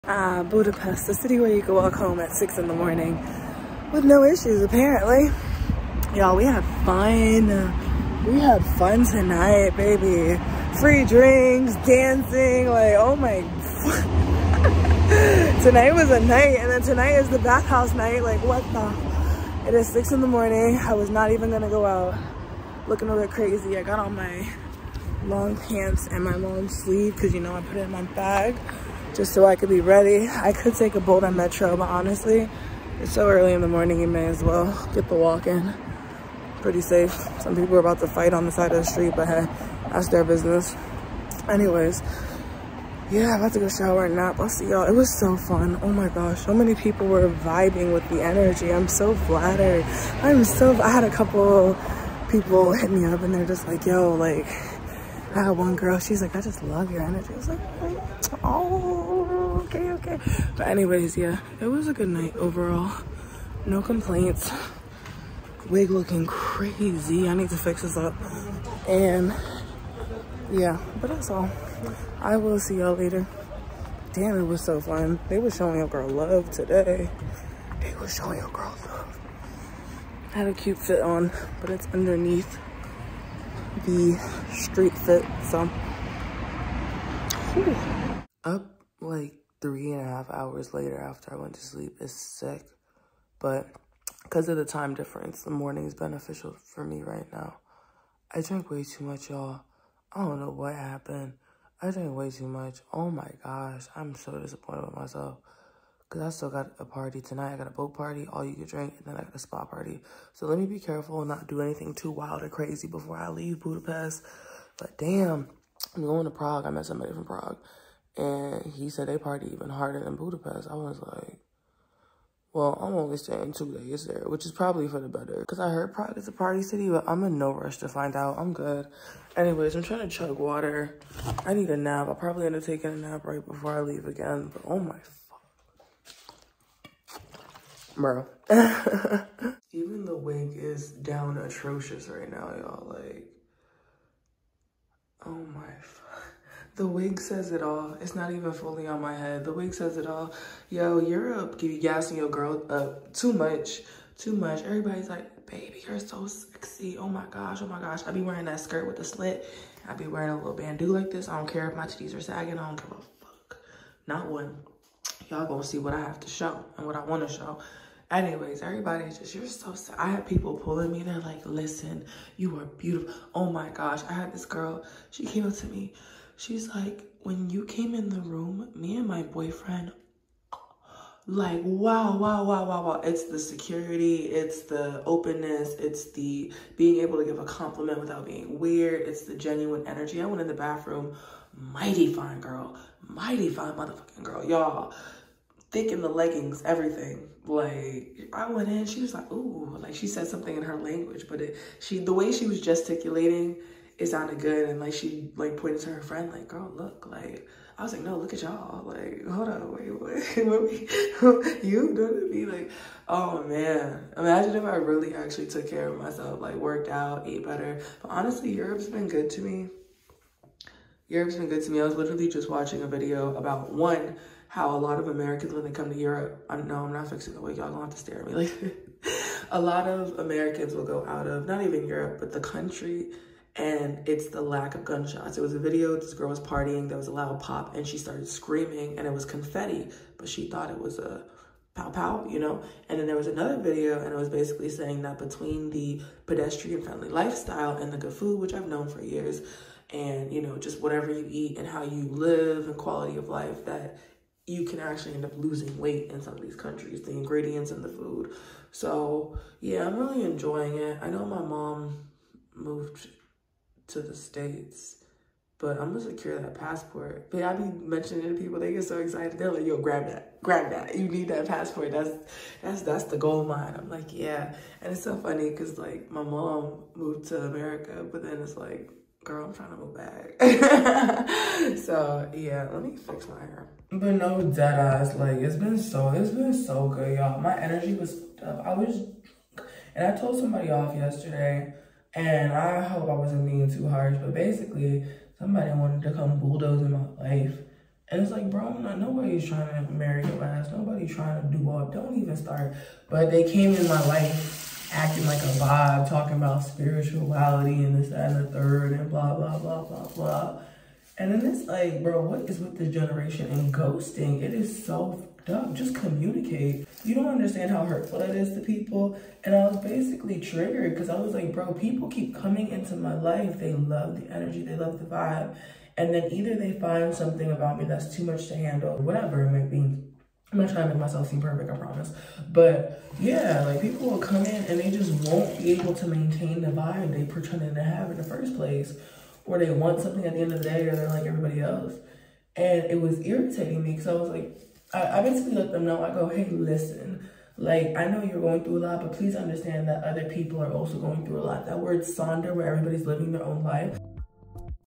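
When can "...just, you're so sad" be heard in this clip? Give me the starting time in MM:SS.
02:49.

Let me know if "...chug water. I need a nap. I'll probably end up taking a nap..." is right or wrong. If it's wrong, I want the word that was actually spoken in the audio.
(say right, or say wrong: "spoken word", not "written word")
right.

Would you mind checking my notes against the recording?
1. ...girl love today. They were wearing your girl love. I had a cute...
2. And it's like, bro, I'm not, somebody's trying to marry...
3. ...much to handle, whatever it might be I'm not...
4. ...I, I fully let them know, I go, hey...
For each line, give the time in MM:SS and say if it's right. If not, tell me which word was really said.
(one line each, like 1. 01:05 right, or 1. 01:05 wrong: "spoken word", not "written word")
1. 01:15 wrong: "showing", not "wearing"
2. 04:58 wrong: "nobody", not "somebody"
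3. 05:28 right
4. 05:44 wrong: "basically", not "fully".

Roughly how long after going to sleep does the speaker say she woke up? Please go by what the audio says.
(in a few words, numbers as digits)
3.5 hours.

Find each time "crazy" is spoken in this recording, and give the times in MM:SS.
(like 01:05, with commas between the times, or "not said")
00:23, 01:06, 01:52.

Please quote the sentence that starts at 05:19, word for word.
And I was basically triggered because I was like, bro, people keep coming into my life.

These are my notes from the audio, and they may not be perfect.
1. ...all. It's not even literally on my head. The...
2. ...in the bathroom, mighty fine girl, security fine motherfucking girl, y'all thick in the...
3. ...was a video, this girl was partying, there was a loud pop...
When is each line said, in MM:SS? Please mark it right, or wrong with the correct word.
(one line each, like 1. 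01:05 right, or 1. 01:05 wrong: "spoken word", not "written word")
1. 02:27 wrong: "fully", not "literally"
2. 03:10 wrong: "mighty", not "security"
3. 03:55 right.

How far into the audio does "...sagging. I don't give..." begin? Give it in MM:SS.
02:42.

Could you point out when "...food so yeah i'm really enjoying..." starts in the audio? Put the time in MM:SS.
04:17.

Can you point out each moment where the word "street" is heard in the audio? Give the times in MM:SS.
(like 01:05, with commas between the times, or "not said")
00:38, 01:24.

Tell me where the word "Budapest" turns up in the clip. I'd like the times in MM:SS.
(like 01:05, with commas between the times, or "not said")
00:00, 01:53, 02:00.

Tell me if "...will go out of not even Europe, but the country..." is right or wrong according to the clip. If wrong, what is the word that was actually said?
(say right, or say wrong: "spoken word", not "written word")
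right.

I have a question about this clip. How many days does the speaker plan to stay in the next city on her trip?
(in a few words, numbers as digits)
2.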